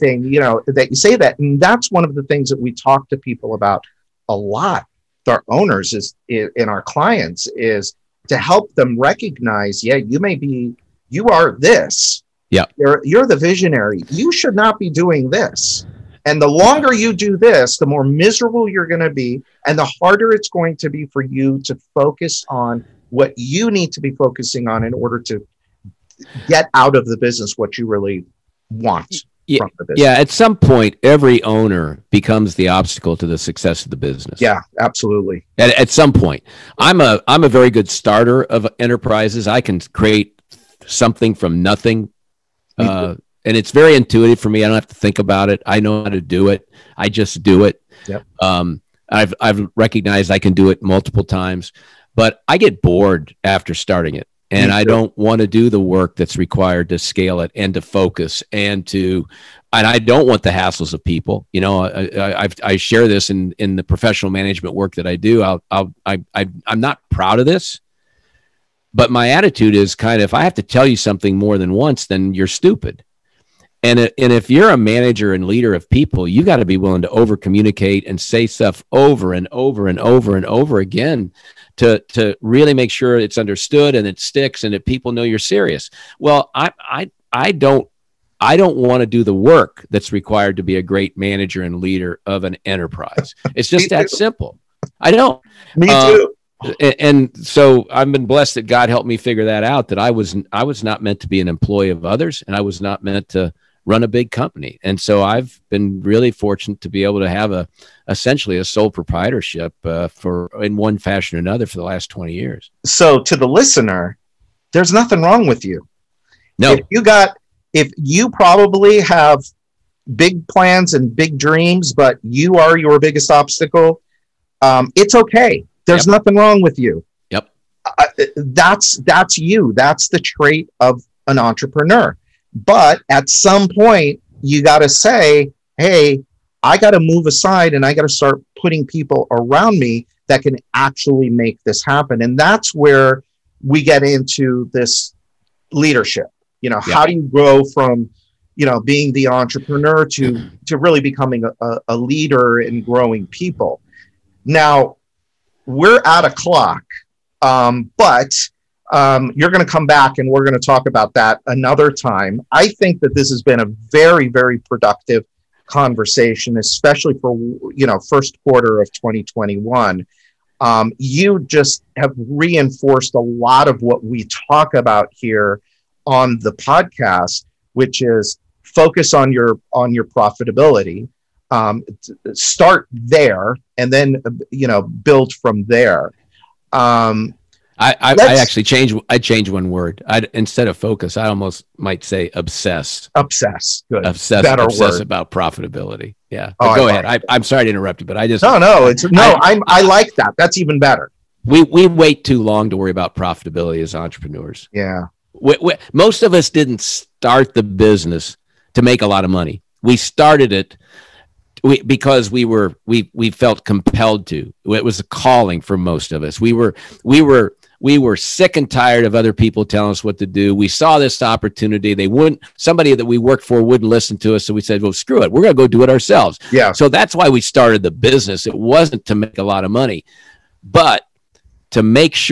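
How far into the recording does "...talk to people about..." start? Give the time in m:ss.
0:02.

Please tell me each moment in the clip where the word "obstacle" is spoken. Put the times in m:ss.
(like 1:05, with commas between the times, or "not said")
0:32, 2:03.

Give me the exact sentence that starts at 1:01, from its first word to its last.
You know, I, I, I share this in in the professional management work that I do.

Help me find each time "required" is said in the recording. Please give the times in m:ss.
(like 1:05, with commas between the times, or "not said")
0:56, 1:30.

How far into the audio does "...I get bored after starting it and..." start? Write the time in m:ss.
0:52.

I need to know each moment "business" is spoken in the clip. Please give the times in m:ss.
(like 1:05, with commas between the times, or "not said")
0:27, 0:33, 3:27, 3:47.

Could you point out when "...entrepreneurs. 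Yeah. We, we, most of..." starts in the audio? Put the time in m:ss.
3:23.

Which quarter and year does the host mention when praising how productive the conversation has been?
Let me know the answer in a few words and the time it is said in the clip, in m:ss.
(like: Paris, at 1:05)
first quarter of 2021, at 2:48.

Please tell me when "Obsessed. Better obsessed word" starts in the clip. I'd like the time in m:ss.
3:14.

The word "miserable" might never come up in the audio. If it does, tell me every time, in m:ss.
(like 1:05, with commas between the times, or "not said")
0:18.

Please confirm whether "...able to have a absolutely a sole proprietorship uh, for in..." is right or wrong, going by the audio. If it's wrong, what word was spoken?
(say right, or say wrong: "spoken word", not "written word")
wrong: "essentially", not "absolutely".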